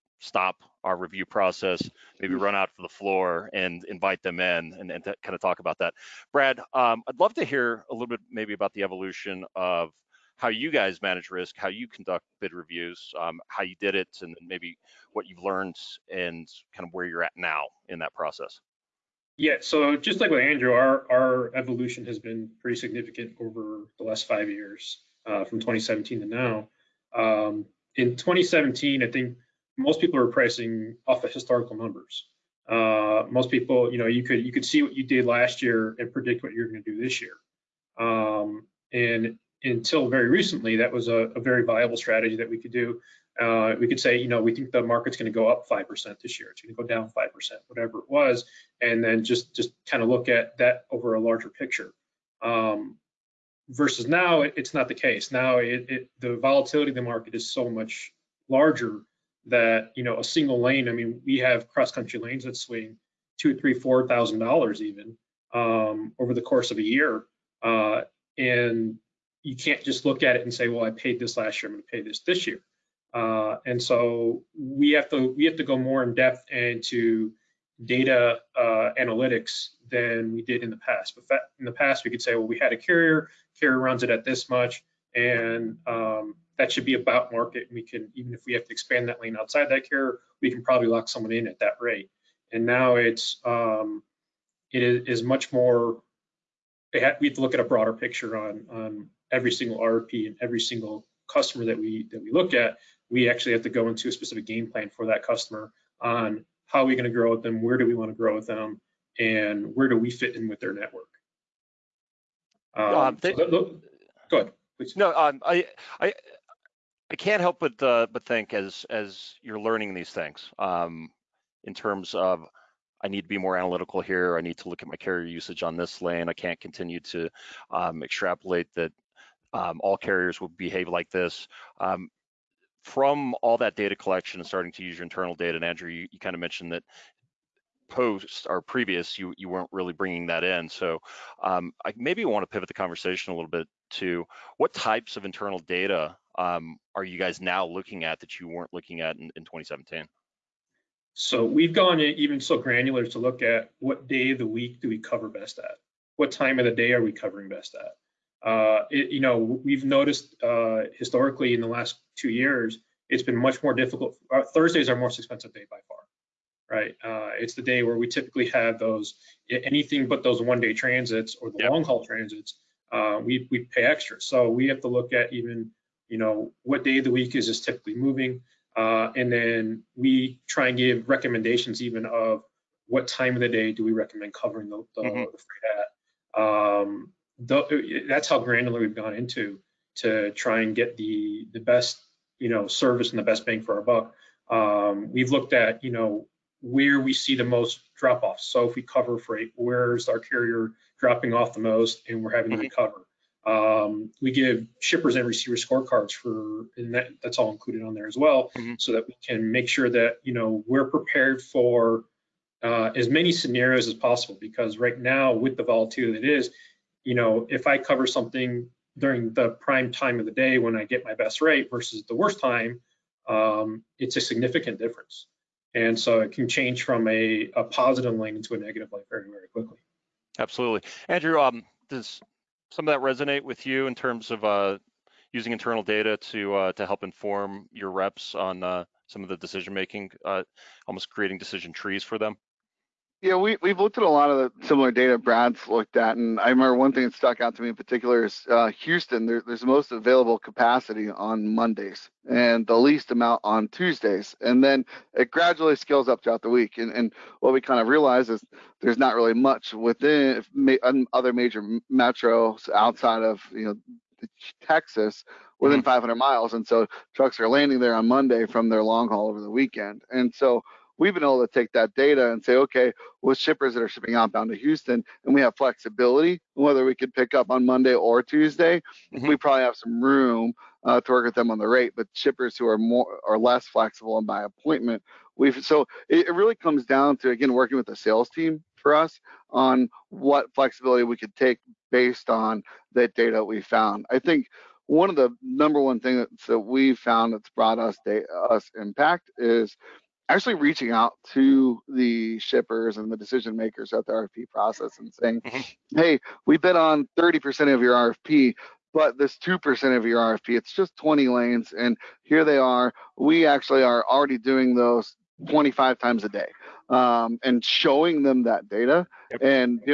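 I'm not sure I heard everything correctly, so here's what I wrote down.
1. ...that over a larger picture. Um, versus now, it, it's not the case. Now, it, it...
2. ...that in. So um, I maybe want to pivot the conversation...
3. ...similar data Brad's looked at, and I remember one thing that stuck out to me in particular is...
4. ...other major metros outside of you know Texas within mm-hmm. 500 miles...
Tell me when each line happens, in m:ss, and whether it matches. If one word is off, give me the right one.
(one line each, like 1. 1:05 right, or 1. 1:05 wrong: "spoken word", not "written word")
1. 0:50 right
2. 2:20 right
3. 4:04 right
4. 4:21 right.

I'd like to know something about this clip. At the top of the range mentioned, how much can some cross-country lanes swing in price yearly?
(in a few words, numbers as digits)
4,000 dollars.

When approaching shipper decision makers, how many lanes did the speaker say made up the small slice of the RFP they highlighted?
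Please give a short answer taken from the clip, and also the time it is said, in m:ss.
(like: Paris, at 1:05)
20, at 5:10.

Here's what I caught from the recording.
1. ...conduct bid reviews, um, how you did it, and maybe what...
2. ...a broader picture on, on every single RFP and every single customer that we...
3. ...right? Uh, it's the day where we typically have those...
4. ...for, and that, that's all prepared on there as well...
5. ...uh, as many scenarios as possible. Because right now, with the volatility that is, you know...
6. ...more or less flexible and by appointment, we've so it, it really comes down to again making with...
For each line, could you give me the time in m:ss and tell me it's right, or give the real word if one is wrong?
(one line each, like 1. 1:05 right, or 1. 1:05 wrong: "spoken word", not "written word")
1. 0:11 right
2. 1:37 right
3. 2:46 right
4. 3:26 wrong: "included", not "prepared"
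5. 3:32 right
6. 4:42 wrong: "working", not "making".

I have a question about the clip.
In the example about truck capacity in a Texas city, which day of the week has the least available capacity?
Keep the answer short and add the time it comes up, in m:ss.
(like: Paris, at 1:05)
Tuesday, at 4:13.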